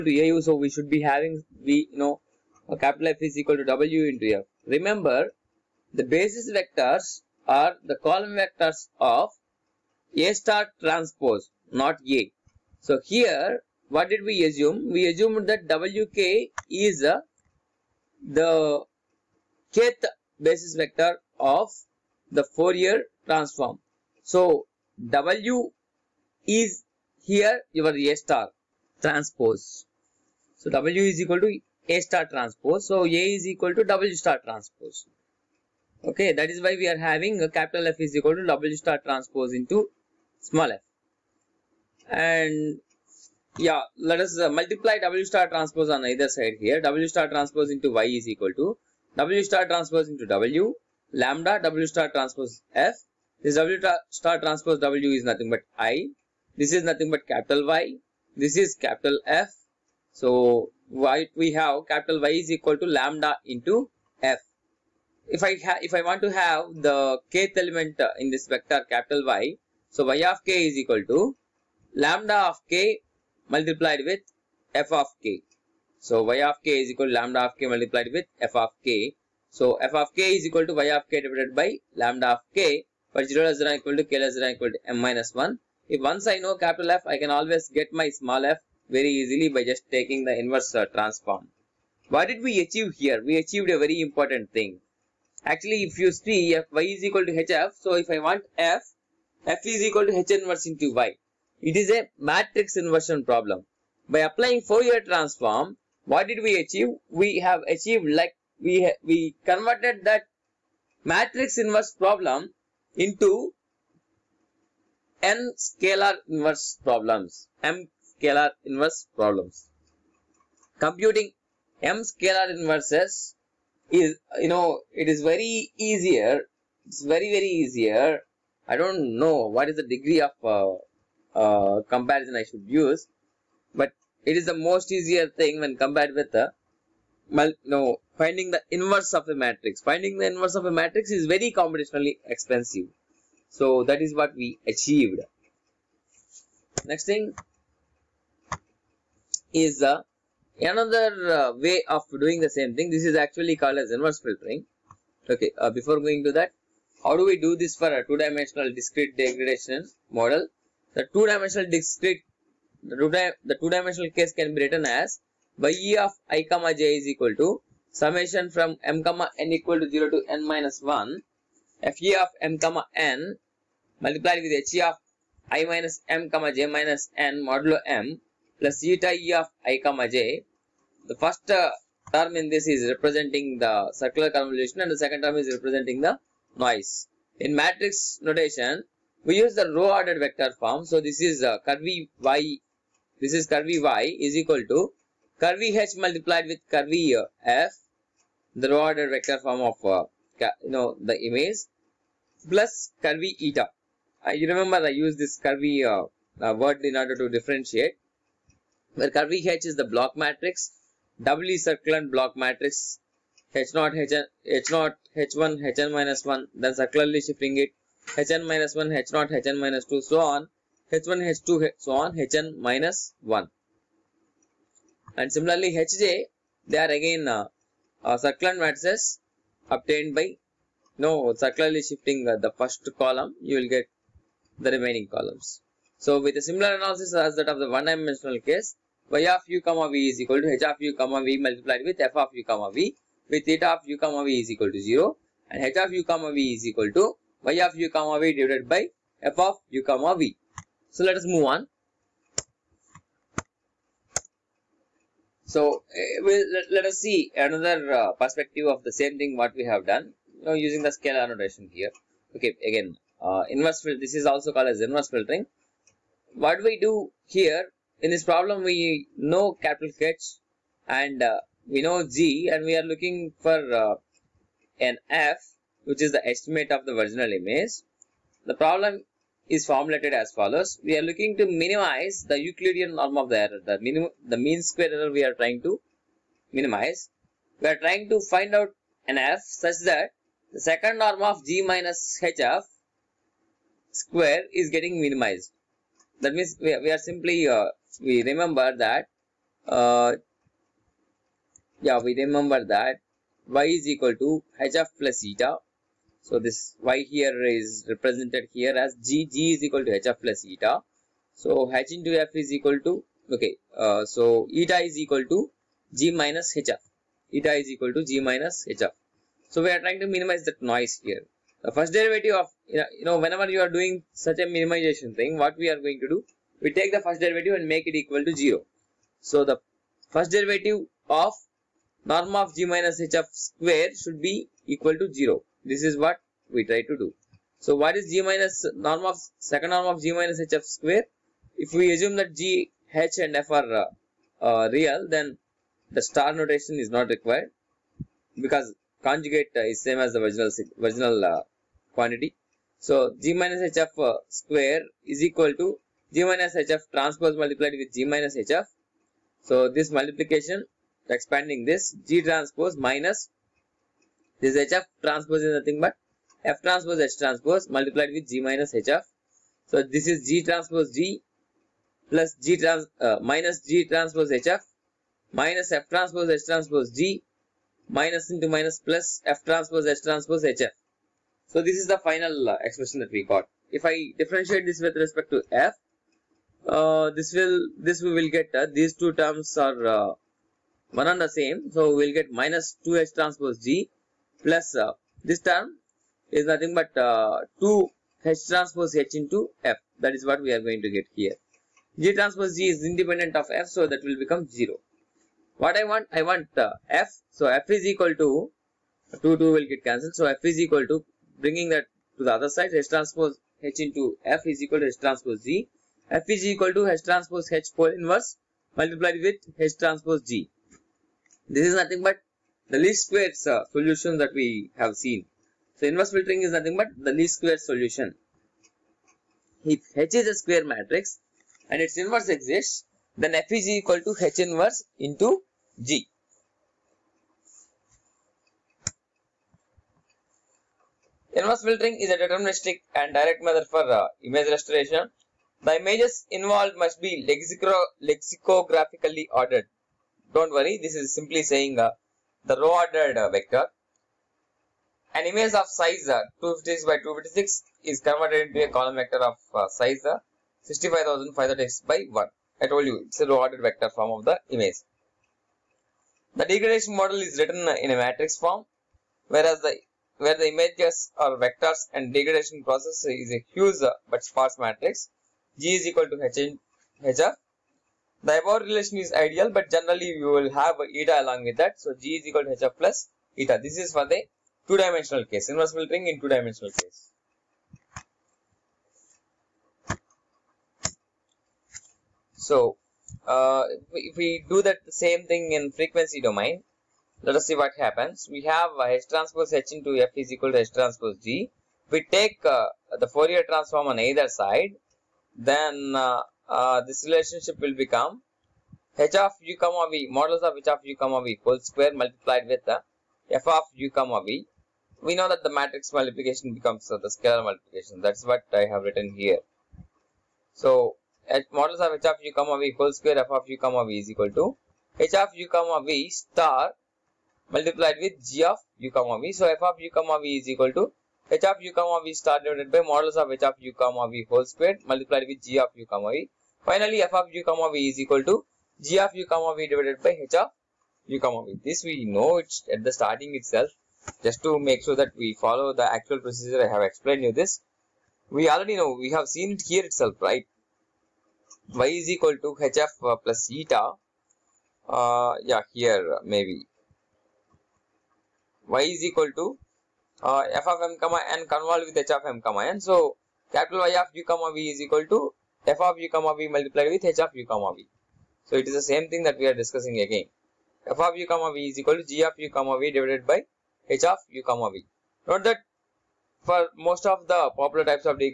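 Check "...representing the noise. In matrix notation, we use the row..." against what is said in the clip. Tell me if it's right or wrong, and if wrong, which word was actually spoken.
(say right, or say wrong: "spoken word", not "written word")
right.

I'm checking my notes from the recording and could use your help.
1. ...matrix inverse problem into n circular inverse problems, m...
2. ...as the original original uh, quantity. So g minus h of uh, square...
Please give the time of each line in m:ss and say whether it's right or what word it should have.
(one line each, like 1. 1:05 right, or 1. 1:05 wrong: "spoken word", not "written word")
1. 1:51 wrong: "scalar", not "circular"
2. 5:49 right.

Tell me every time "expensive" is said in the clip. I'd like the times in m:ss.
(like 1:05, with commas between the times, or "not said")
2:22.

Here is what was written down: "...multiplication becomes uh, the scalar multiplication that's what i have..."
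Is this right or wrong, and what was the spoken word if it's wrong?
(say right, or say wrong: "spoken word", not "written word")
right.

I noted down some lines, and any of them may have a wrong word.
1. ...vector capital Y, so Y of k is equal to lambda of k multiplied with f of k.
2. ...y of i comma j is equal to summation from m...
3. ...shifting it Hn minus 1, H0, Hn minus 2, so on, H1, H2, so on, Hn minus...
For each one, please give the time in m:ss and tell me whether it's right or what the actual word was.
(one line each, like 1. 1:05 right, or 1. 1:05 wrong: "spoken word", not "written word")
1. 1:08 right
2. 2:45 right
3. 3:37 right.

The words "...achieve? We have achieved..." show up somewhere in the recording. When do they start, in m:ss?
1:46.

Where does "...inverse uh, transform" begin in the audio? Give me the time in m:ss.
1:30.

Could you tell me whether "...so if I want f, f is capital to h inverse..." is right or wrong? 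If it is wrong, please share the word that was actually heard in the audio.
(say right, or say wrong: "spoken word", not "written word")
wrong: "equal", not "capital".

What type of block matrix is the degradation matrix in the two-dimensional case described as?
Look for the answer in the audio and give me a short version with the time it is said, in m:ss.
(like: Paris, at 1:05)
doubly circulant block matrix, at 3:31.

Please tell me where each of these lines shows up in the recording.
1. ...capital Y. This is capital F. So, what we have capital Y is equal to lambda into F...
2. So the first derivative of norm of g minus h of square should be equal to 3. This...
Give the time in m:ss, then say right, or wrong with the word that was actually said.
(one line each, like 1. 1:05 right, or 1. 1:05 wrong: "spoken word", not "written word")
1. 0:57 right
2. 5:29 wrong: "0", not "3".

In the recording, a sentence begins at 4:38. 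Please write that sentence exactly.
The problem is formulated as follows.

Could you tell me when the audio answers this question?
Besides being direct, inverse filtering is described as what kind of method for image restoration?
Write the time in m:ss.
7:22.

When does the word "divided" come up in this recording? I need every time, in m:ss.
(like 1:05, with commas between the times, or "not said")
1:21, 4:08, 8:52, 8:59, 9:32.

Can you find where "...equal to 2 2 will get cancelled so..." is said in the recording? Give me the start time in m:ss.
6:47.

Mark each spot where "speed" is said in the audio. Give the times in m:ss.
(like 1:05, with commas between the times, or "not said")
not said.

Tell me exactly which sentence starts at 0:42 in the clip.
And yeah, let us uh, multiply W star transpose on either side here.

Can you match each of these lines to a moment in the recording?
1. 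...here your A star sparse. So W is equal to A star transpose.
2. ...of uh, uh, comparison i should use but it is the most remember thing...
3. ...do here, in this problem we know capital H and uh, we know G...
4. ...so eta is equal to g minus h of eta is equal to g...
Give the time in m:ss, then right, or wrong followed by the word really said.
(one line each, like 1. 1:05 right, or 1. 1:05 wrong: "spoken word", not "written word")
1. 0:27 wrong: "transpose", not "sparse"
2. 2:10 wrong: "easier", not "remember"
3. 4:26 right
4. 5:14 right.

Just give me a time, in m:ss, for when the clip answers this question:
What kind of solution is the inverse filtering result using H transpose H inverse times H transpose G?
7:02.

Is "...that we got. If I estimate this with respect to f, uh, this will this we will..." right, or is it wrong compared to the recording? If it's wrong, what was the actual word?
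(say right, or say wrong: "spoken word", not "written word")
wrong: "differentiate", not "estimate".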